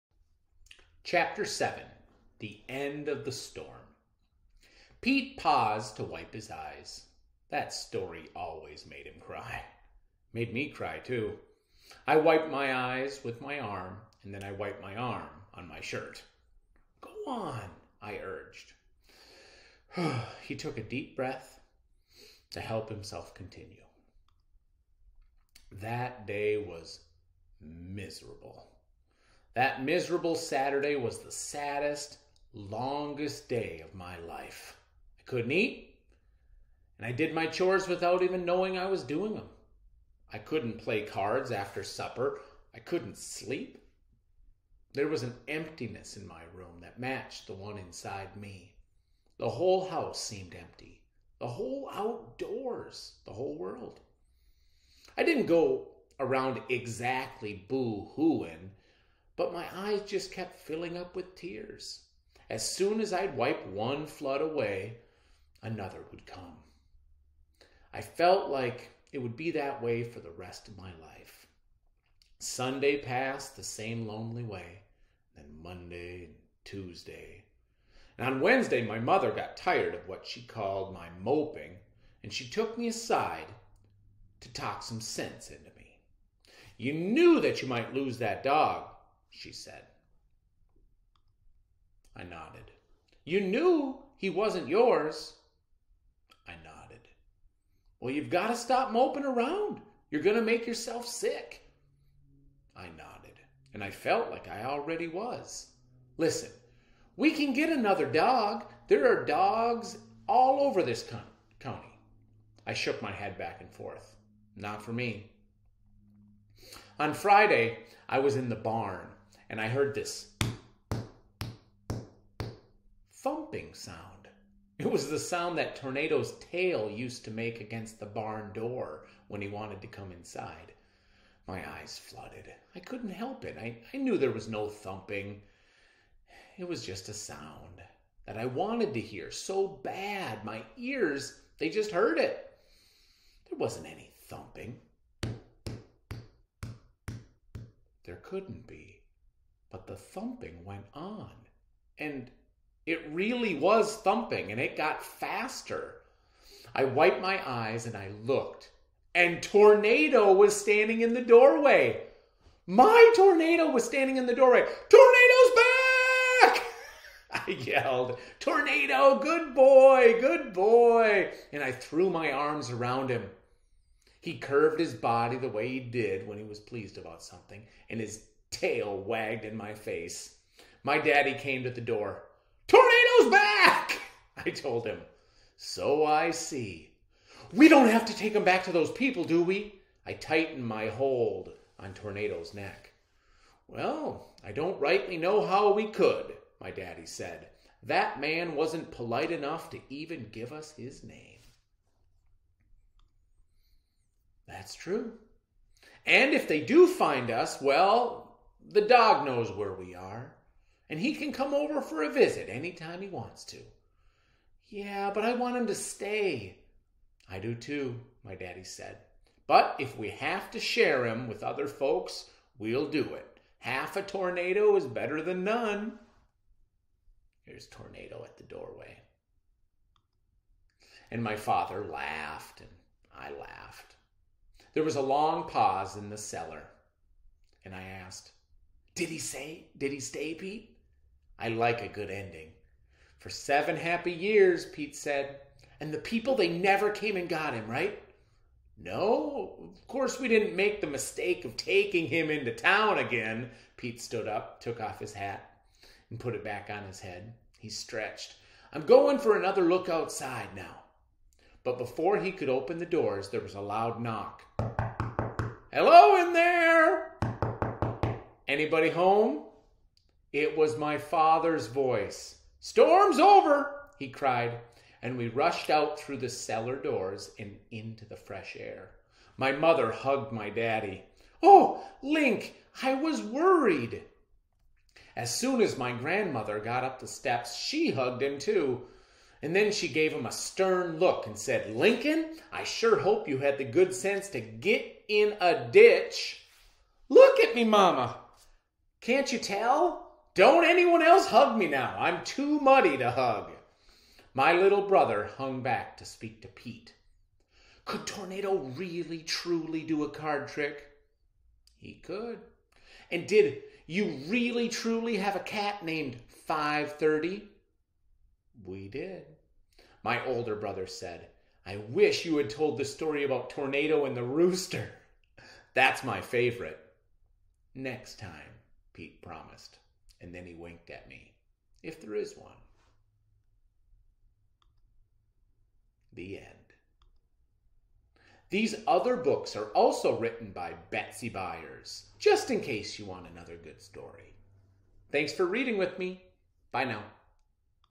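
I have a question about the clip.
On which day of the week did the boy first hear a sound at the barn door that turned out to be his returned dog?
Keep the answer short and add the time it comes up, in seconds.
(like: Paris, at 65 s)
Friday, at 116 s.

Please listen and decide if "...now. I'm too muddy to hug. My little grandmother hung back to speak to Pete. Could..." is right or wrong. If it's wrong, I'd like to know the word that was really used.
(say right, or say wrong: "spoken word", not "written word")
wrong: "brother", not "grandmother".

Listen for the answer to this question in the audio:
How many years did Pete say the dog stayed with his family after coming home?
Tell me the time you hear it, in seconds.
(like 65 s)
243 s.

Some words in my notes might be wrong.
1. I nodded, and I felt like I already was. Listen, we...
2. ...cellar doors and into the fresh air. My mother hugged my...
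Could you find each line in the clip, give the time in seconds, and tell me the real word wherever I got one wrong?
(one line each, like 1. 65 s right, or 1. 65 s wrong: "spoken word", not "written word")
1. 102 s right
2. 276 s right.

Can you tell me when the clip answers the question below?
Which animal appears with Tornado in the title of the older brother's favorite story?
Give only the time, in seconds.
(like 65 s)
324 s.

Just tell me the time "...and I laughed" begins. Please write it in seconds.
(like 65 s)
232 s.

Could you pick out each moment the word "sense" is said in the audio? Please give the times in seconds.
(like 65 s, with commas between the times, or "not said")
85 s, 293 s.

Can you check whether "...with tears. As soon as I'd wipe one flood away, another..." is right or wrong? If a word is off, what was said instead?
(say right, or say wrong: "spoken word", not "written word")
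right.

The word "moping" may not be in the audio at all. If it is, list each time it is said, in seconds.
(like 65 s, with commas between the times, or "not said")
81 s, 98 s.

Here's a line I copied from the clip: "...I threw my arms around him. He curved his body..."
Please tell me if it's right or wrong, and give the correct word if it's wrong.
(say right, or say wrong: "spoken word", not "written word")
right.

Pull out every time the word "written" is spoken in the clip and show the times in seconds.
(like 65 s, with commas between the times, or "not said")
340 s.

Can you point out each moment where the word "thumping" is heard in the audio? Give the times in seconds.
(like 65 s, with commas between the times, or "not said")
123 s, 134 s, 144 s, 149 s, 154 s.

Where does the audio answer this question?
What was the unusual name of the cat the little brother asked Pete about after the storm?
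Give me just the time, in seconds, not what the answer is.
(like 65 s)
316 s.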